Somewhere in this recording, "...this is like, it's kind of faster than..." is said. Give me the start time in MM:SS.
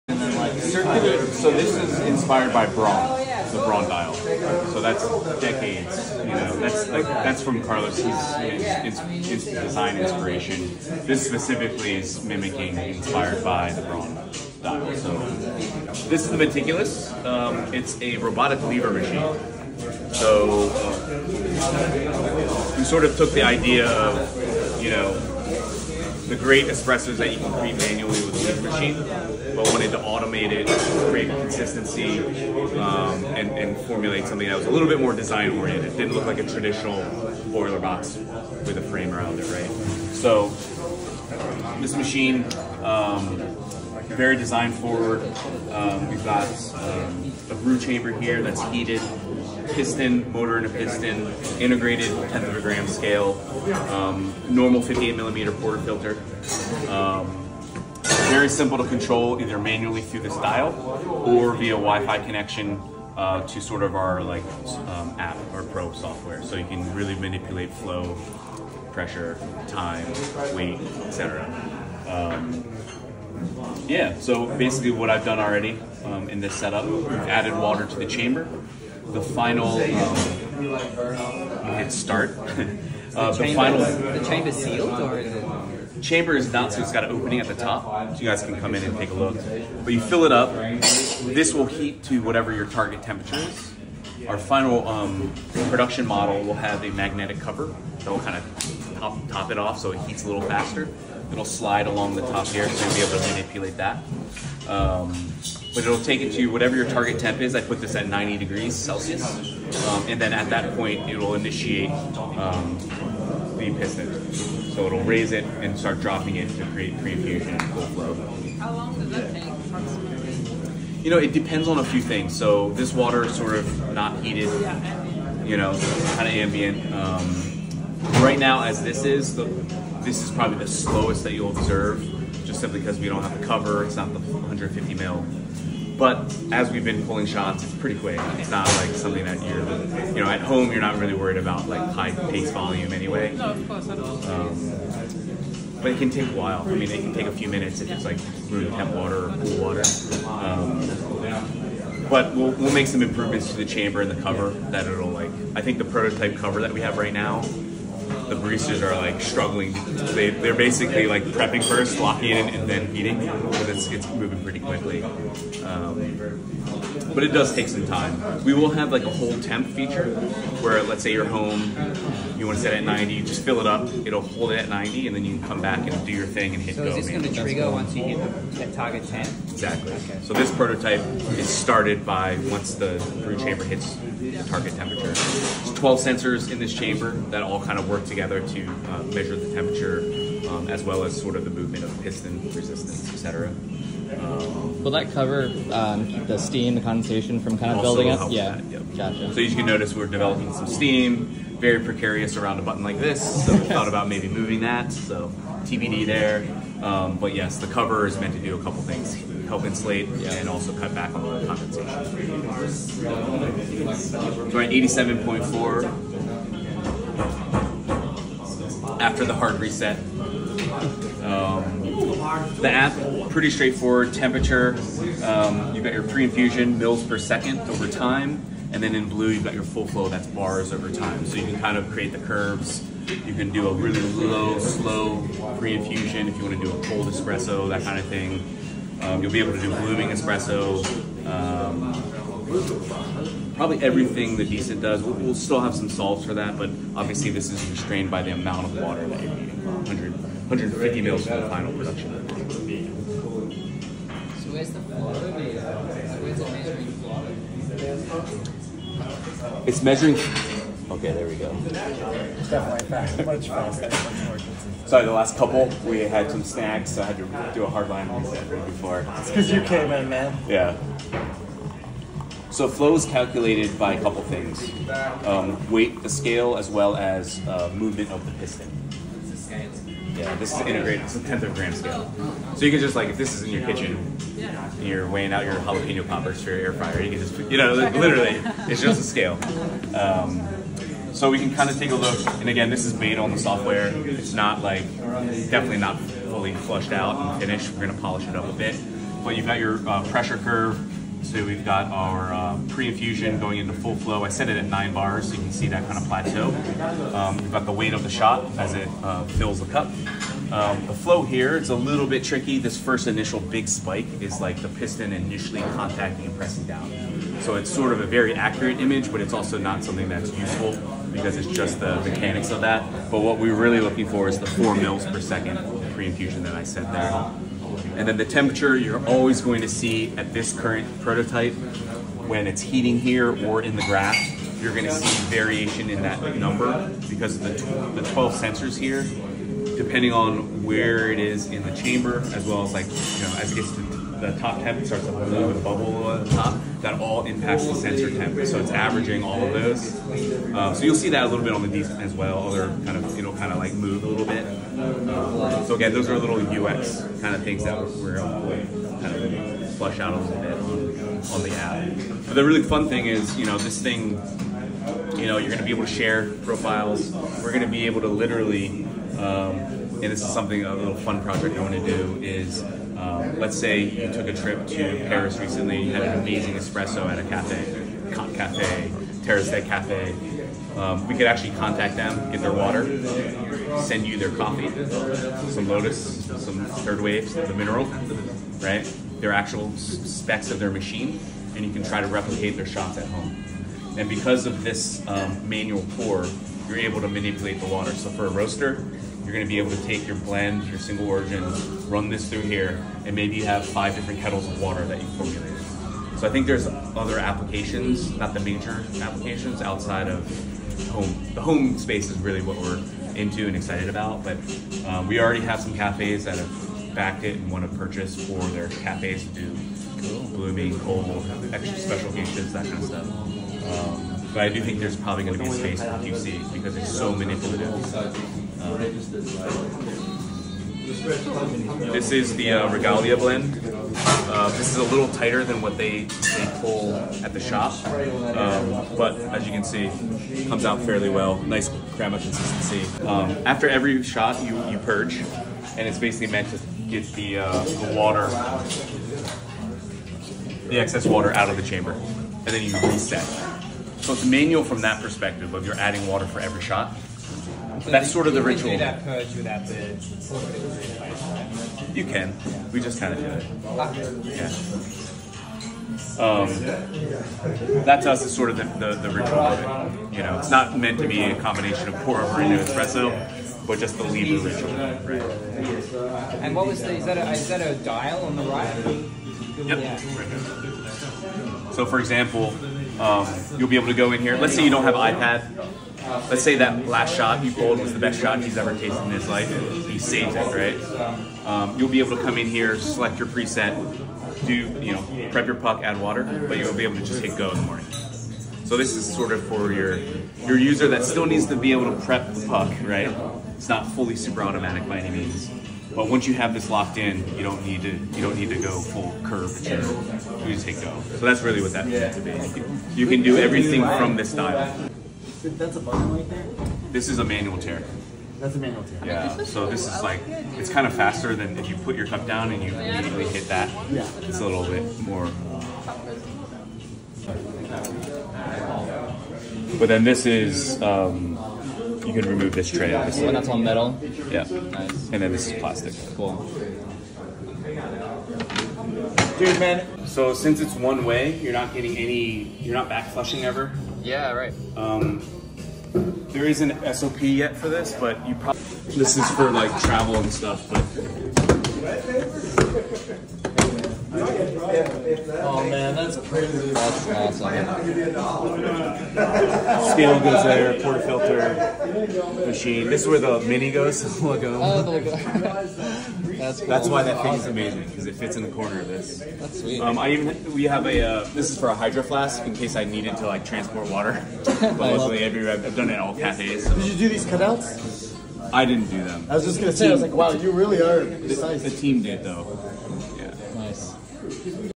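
08:39.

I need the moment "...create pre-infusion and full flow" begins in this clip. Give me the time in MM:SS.
01:56.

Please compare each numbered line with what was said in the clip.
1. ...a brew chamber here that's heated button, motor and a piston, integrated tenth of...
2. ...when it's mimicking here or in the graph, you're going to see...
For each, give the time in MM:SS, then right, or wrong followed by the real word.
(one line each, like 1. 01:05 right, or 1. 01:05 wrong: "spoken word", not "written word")
1. 00:47 wrong: "piston", not "button"
2. 05:32 wrong: "heating", not "mimicking".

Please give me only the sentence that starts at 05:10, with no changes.
Um, the flow here, it's a little bit tricky.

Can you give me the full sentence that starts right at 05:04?
I set it at nine bars, so you can see that kind of plateau.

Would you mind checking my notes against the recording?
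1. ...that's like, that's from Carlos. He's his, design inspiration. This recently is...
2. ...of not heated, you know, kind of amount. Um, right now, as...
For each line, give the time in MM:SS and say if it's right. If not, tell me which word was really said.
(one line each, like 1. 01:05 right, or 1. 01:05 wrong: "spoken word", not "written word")
1. 00:06 wrong: "specifically", not "recently"
2. 02:03 wrong: "ambient", not "amount".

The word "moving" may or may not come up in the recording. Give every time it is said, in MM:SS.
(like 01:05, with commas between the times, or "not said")
02:44, 03:24.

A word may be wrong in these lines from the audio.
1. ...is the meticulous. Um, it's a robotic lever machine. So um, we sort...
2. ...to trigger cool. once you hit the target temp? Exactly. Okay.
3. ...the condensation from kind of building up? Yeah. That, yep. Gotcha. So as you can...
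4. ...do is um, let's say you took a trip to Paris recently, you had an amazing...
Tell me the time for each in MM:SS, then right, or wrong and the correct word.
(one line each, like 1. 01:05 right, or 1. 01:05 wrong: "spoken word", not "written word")
1. 00:16 right
2. 02:57 right
3. 03:16 right
4. 06:11 right.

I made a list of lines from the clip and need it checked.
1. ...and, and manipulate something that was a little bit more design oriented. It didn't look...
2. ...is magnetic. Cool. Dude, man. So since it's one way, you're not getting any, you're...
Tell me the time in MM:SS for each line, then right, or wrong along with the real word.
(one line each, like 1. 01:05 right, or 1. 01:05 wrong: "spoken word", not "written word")
1. 00:33 wrong: "formulate", not "manipulate"
2. 08:55 wrong: "plastic", not "magnetic".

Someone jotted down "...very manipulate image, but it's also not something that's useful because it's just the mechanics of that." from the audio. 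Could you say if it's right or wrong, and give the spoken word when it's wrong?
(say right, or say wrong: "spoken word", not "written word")
wrong: "accurate", not "manipulate".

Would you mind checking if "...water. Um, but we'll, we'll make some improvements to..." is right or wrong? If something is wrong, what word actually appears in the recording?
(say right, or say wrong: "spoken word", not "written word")
right.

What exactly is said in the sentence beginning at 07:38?
that purge without the You can.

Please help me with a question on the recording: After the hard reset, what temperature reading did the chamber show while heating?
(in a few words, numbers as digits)
87.4.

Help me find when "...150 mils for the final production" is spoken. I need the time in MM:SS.
04:10.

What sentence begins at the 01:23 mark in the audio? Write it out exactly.
The chamber sealed or is it?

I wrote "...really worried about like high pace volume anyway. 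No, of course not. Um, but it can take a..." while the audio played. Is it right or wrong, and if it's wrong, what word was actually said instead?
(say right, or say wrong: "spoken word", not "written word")
right.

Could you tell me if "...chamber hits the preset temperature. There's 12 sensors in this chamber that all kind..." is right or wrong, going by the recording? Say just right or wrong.
wrong.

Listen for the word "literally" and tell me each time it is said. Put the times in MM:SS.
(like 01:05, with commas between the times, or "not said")
04:47, 06:08.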